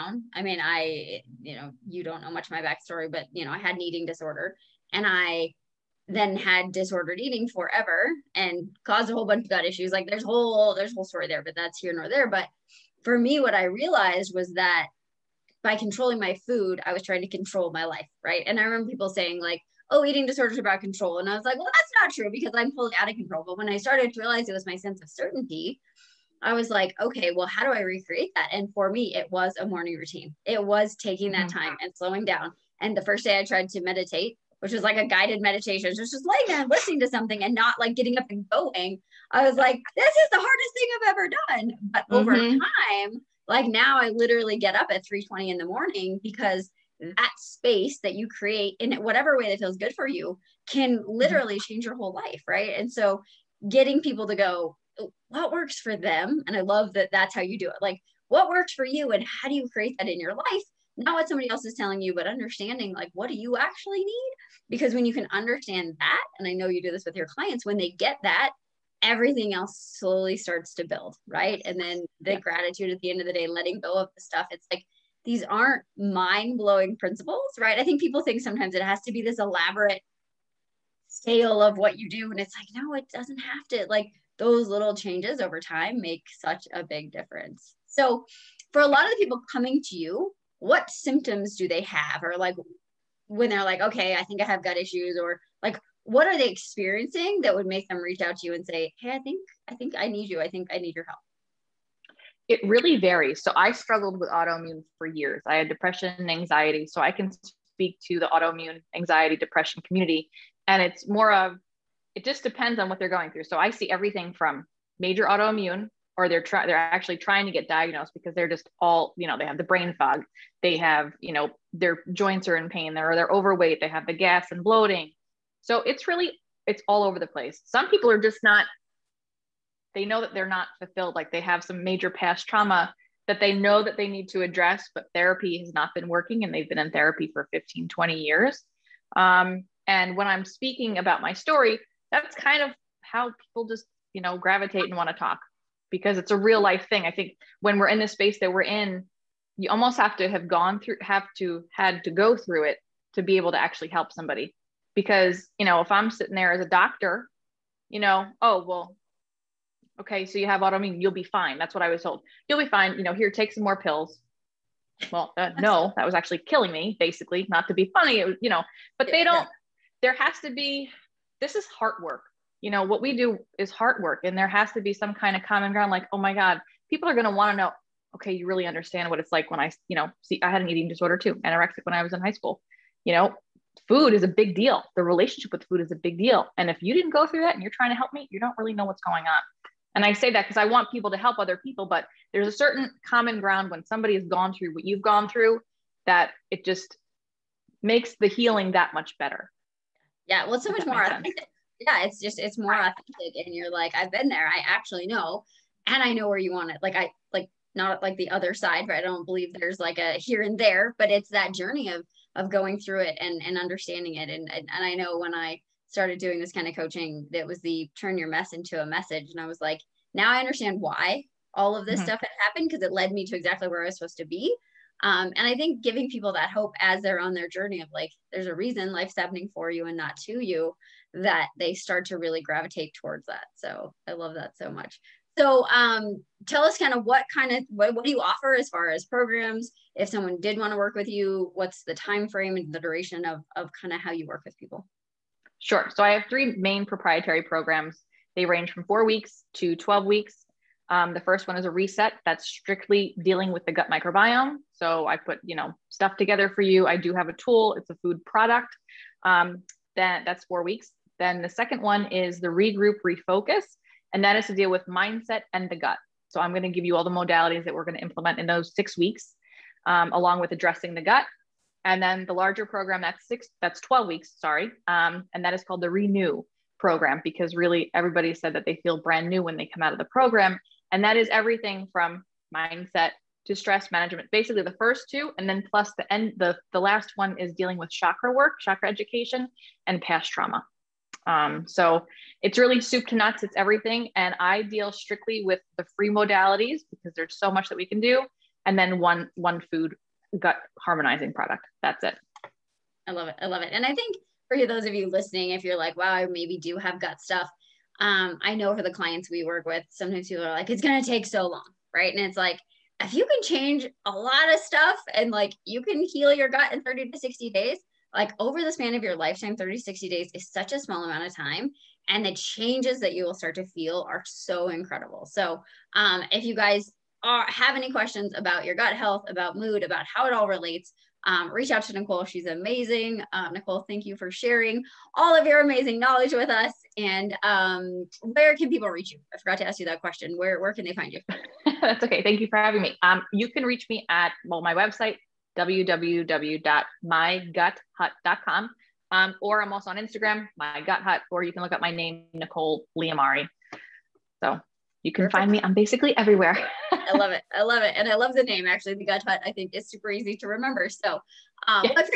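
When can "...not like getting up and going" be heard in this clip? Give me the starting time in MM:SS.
00:37.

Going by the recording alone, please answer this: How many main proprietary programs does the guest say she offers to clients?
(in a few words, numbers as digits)
3.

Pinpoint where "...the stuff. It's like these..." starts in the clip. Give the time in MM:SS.
01:14.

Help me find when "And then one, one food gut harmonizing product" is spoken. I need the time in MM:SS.
04:58.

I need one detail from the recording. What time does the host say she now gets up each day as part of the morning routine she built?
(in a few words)
3:20.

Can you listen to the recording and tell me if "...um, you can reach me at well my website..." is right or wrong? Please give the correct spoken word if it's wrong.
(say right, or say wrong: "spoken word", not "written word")
right.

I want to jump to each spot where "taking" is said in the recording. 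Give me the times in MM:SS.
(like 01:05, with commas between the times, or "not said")
00:30.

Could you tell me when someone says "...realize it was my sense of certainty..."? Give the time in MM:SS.
00:24.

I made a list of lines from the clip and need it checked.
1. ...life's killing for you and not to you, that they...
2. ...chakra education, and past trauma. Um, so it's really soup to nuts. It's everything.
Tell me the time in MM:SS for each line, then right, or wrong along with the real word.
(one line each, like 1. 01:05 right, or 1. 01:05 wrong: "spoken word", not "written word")
1. 03:48 wrong: "happening", not "killing"
2. 04:48 right.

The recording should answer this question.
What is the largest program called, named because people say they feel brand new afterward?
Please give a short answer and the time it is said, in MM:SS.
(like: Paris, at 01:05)
Renew, at 04:35.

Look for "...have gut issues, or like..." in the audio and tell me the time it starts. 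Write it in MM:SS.
01:34.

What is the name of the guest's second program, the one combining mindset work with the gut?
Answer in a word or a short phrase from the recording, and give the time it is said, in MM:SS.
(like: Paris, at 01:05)
Regroup Refocus, at 04:22.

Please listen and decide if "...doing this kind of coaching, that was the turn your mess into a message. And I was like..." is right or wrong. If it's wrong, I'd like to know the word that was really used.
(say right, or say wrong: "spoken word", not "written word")
right.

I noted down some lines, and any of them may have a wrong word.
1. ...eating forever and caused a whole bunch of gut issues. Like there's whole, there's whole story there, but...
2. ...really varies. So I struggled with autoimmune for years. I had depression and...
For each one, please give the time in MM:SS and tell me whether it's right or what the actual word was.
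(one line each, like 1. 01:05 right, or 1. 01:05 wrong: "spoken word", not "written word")
1. 00:07 right
2. 01:42 right.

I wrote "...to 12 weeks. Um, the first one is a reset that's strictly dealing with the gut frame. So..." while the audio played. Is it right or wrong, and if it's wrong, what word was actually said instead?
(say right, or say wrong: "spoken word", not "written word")
wrong: "microbiome", not "frame".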